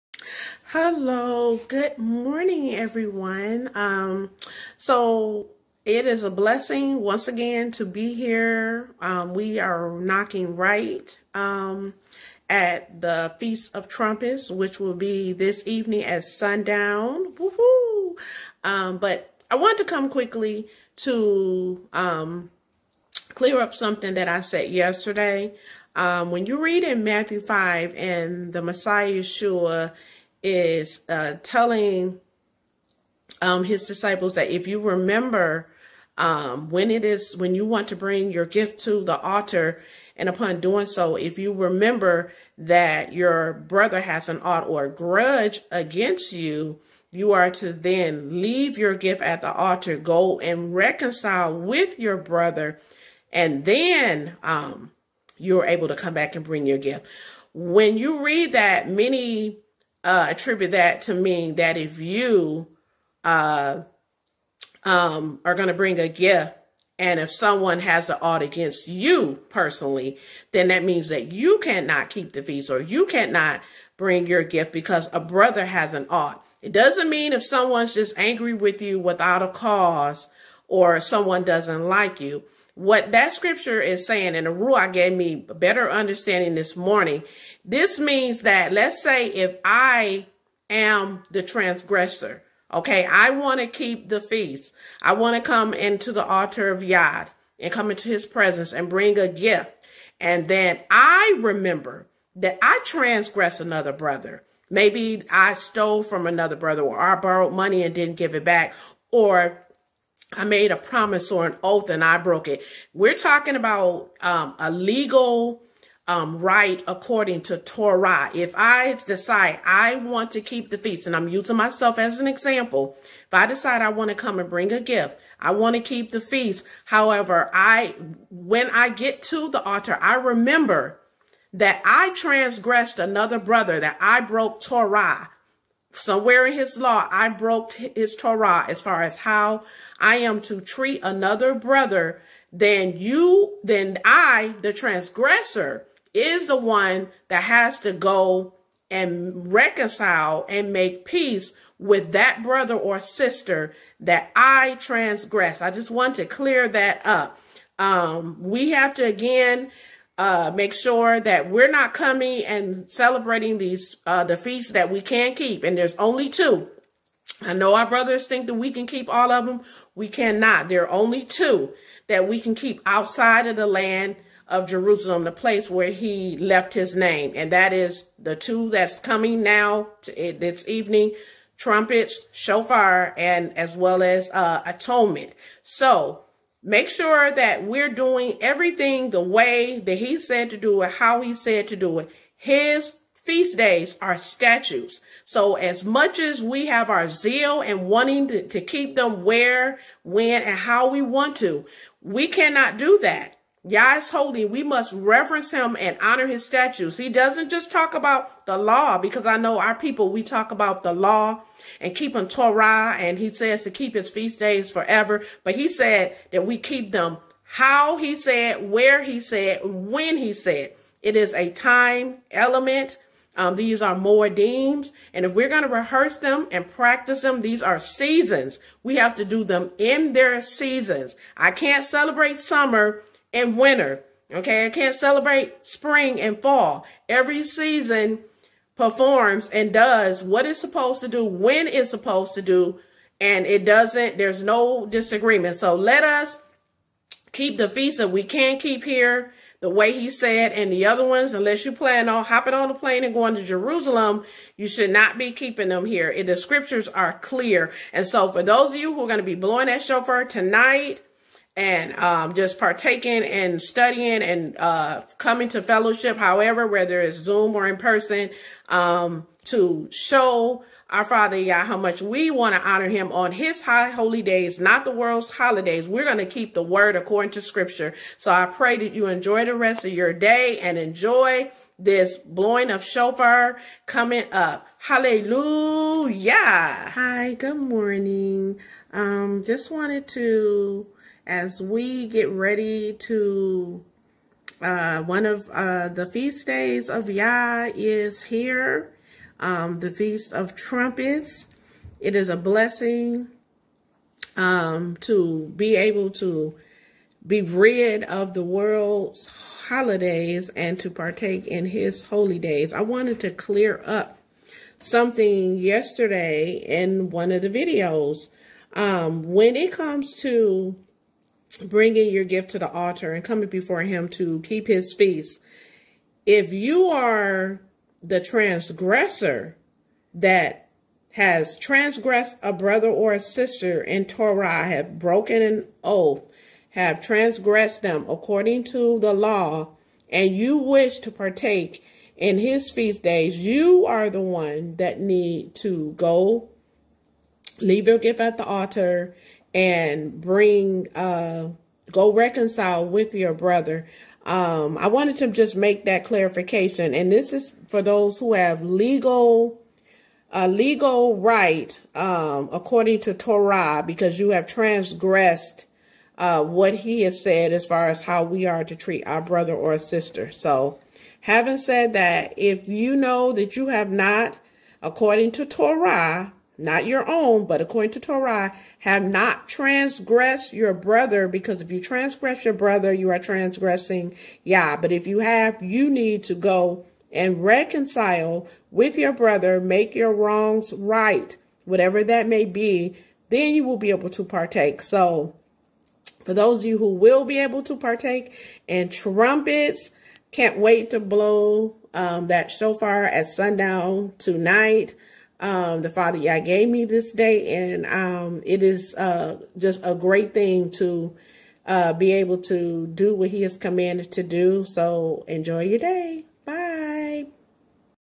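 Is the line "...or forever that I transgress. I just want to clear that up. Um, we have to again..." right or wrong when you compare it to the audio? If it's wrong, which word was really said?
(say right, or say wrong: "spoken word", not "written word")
wrong: "sister", not "forever".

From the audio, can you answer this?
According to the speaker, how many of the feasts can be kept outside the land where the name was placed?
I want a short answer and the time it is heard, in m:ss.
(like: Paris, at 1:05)
2, at 2:45.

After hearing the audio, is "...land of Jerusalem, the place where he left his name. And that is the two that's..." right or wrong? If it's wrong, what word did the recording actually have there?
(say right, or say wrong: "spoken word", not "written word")
right.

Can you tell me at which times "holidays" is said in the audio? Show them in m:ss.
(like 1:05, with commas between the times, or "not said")
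4:35, 5:09.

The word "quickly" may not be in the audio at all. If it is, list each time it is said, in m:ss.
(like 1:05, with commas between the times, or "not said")
0:20.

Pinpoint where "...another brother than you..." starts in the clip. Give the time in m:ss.
2:21.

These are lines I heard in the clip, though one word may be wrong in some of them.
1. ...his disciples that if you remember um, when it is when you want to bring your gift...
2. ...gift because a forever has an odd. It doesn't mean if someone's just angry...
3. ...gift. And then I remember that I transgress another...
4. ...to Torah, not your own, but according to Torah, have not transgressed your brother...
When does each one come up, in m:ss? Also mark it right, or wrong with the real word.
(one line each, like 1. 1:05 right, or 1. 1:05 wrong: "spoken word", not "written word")
1. 0:33 right
2. 1:14 wrong: "brother", not "forever"
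3. 1:39 right
4. 6:15 right.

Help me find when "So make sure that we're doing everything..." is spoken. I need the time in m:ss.
3:05.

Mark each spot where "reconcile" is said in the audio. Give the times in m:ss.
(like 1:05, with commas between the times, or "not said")
0:50, 2:29, 5:52, 6:27.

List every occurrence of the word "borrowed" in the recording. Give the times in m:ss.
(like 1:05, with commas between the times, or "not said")
1:47.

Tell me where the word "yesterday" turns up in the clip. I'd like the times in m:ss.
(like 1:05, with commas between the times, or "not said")
0:24, 5:15.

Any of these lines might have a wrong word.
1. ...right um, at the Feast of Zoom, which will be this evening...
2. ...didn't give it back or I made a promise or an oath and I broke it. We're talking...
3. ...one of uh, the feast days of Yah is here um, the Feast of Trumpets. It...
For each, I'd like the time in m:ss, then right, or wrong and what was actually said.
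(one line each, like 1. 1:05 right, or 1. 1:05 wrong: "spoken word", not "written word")
1. 0:10 wrong: "Trumpets", not "Zoom"
2. 1:47 right
3. 4:55 right.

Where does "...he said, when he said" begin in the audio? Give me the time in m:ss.
3:39.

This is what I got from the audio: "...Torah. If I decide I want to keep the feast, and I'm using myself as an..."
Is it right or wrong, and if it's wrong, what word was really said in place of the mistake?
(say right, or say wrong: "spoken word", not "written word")
right.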